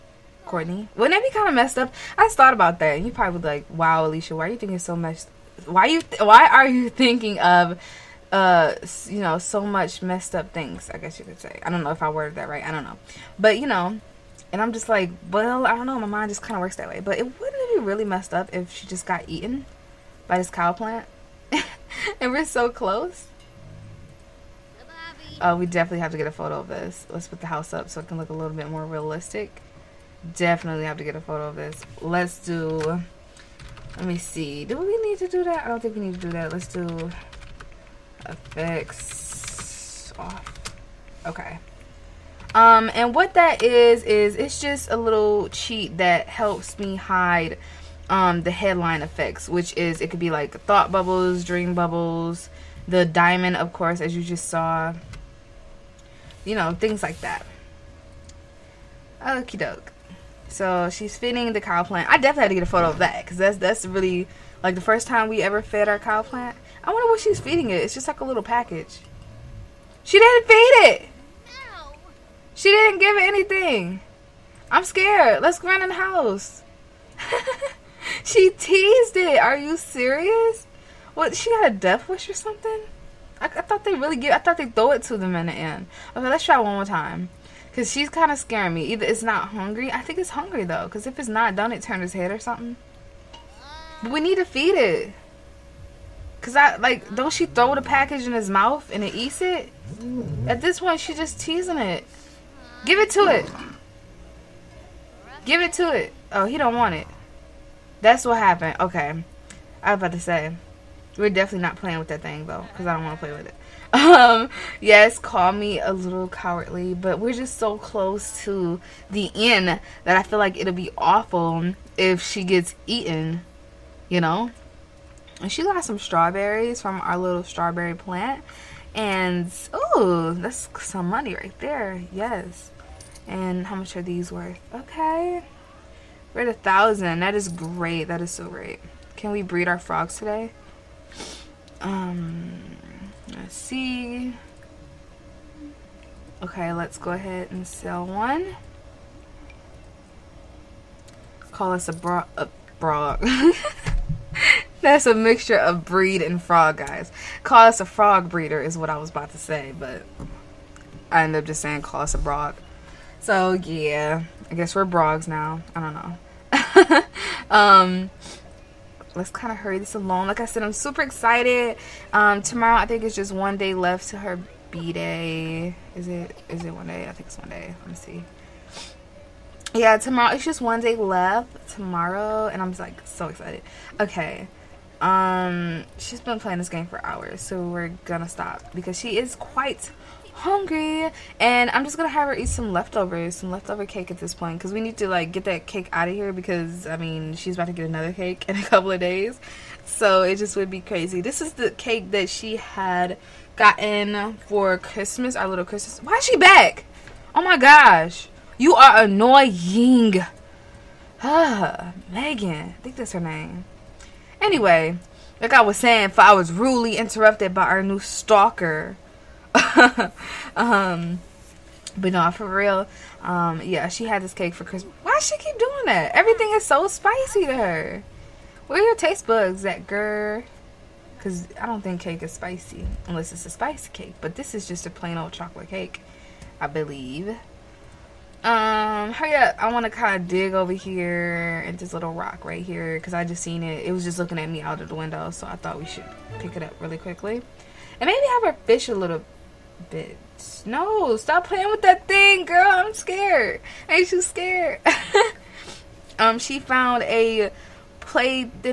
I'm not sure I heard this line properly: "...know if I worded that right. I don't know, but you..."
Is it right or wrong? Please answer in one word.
right.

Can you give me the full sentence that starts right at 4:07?
And maybe have her fish a little no, stop playing with that thing, girl.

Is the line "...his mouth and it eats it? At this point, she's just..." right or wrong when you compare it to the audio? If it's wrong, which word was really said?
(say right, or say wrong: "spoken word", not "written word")
right.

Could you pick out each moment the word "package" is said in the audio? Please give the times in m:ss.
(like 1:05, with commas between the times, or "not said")
1:08, 1:37.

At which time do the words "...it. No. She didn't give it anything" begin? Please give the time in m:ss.
1:10.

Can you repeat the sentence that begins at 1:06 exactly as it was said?
I wonder what she's feeding it.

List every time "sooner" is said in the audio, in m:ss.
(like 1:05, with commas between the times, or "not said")
not said.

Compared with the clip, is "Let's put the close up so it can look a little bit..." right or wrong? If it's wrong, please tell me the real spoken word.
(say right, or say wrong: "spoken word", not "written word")
wrong: "house", not "close".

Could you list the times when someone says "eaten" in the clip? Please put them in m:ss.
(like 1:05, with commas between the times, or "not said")
0:19, 2:02.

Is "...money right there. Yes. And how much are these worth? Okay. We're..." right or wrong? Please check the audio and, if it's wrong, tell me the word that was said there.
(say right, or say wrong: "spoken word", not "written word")
right.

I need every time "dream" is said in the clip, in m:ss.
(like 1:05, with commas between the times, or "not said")
0:51.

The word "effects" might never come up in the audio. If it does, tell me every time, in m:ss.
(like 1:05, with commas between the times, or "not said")
0:38, 0:49.